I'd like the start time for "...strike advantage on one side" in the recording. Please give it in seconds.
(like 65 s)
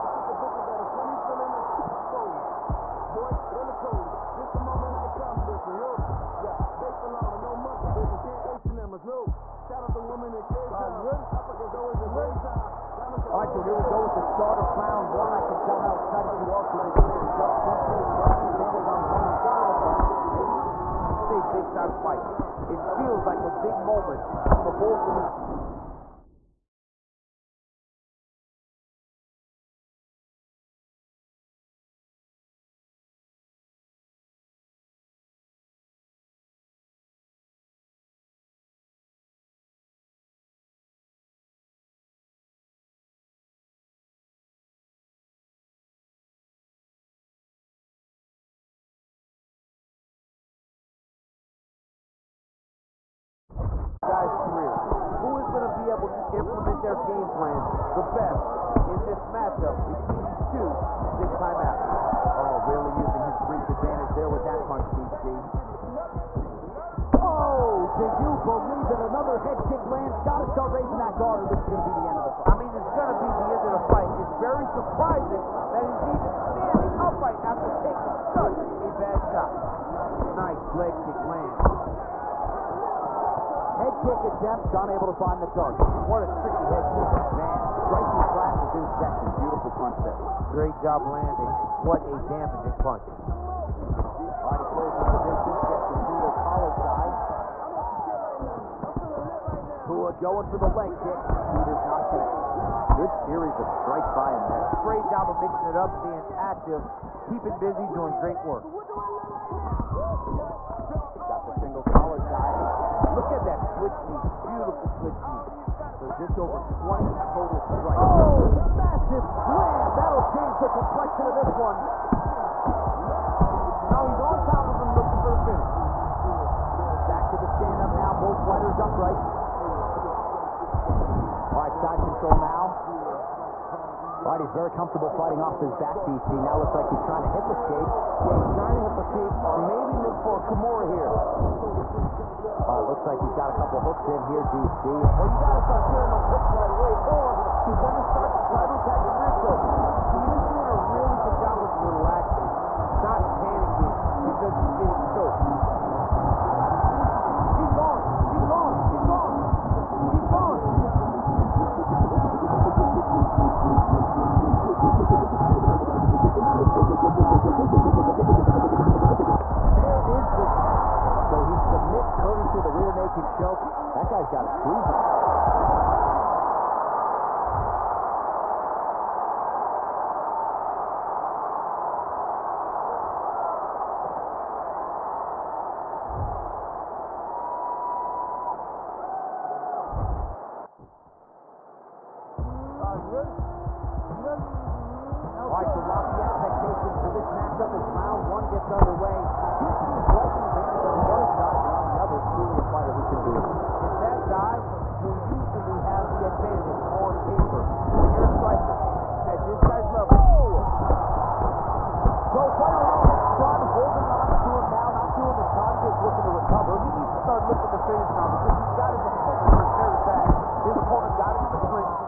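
18 s.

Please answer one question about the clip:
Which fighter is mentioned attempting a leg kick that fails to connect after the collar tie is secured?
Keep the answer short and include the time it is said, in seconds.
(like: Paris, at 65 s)
Rua, at 99 s.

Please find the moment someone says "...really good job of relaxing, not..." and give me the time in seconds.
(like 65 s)
150 s.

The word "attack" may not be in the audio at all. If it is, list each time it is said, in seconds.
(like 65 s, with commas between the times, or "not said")
148 s.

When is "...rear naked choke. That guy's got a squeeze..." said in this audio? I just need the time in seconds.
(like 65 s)
172 s.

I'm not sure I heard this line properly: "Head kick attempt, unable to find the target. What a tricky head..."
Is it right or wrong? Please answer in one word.
right.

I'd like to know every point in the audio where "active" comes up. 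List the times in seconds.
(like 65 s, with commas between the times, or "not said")
106 s.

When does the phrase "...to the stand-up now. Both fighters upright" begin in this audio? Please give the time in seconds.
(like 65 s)
127 s.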